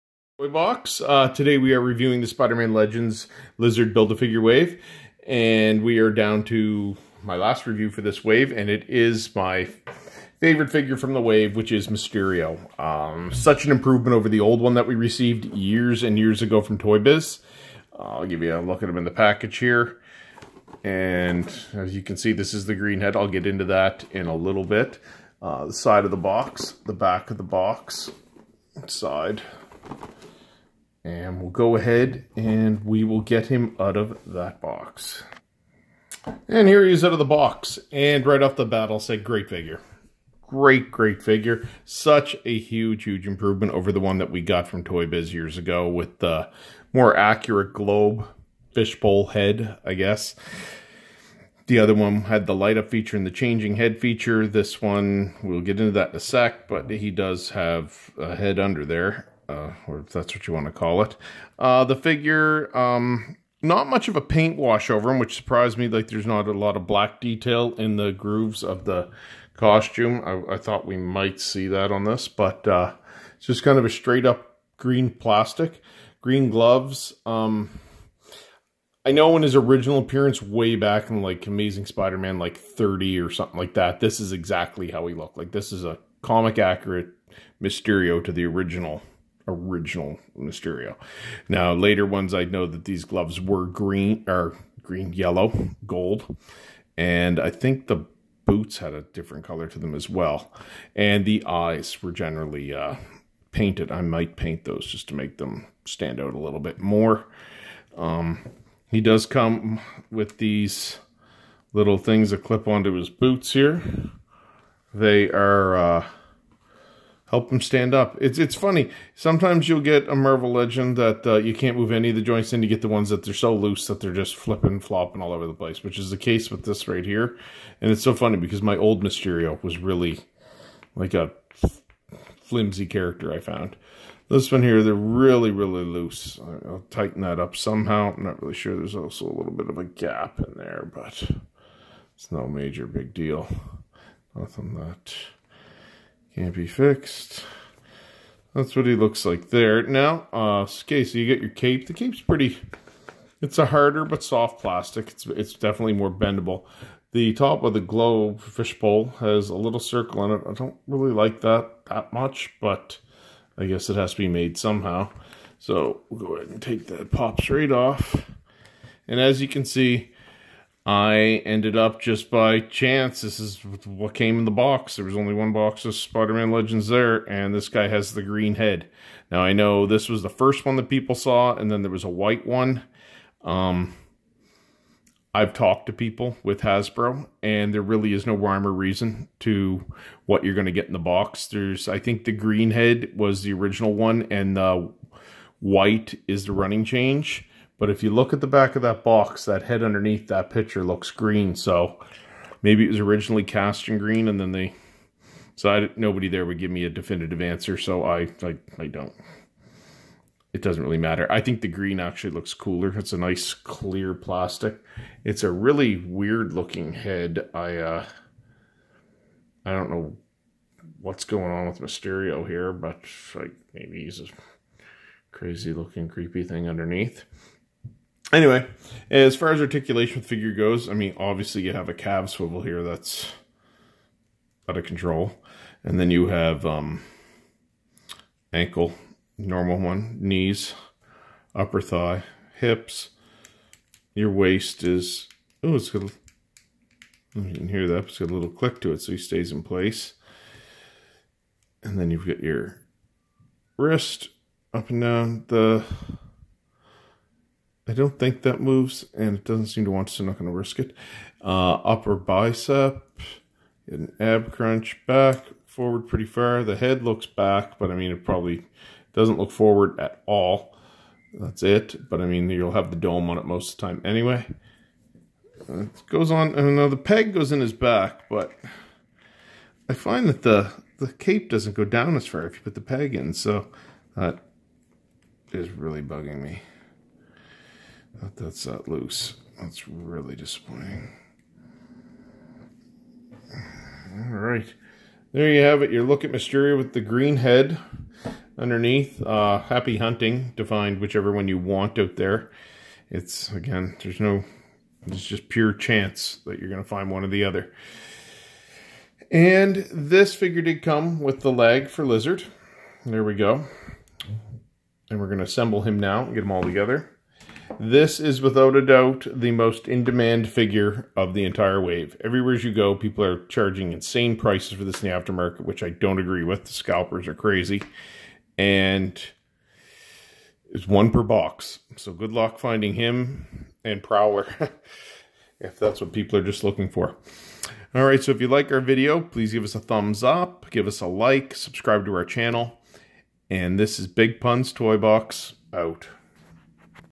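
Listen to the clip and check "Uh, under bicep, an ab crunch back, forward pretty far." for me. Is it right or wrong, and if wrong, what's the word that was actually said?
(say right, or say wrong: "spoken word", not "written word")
wrong: "upper", not "under".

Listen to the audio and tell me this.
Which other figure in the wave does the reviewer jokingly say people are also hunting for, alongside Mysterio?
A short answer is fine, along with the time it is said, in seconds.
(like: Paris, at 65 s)
Prowler, at 334 s.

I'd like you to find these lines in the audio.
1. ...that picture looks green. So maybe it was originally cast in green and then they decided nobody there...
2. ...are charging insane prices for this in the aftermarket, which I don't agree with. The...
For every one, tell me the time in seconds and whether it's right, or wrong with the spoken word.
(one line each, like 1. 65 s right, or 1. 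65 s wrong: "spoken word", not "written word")
1. 200 s right
2. 323 s right.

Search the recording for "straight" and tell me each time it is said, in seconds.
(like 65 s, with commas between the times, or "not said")
73 s, 167 s.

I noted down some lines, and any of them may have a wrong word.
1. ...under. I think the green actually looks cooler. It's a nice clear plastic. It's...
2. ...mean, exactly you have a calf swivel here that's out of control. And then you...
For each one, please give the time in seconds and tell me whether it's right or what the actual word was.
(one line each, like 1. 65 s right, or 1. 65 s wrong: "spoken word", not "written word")
1. 210 s wrong: "matter", not "under"
2. 230 s wrong: "obviously", not "exactly".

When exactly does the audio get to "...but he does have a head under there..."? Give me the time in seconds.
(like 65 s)
56 s.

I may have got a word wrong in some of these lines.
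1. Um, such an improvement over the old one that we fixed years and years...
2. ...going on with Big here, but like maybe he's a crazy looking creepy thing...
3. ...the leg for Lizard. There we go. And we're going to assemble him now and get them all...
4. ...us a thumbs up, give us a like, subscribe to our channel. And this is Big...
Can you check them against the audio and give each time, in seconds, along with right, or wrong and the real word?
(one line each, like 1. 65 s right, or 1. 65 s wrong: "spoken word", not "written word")
1. 12 s wrong: "received", not "fixed"
2. 221 s wrong: "Mysterio", not "Big"
3. 311 s right
4. 339 s right.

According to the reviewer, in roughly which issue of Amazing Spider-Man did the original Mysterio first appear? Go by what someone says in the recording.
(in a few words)
30.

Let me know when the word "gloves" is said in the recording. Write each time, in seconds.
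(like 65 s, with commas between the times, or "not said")
76 s, 93 s.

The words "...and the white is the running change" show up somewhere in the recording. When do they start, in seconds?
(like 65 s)
194 s.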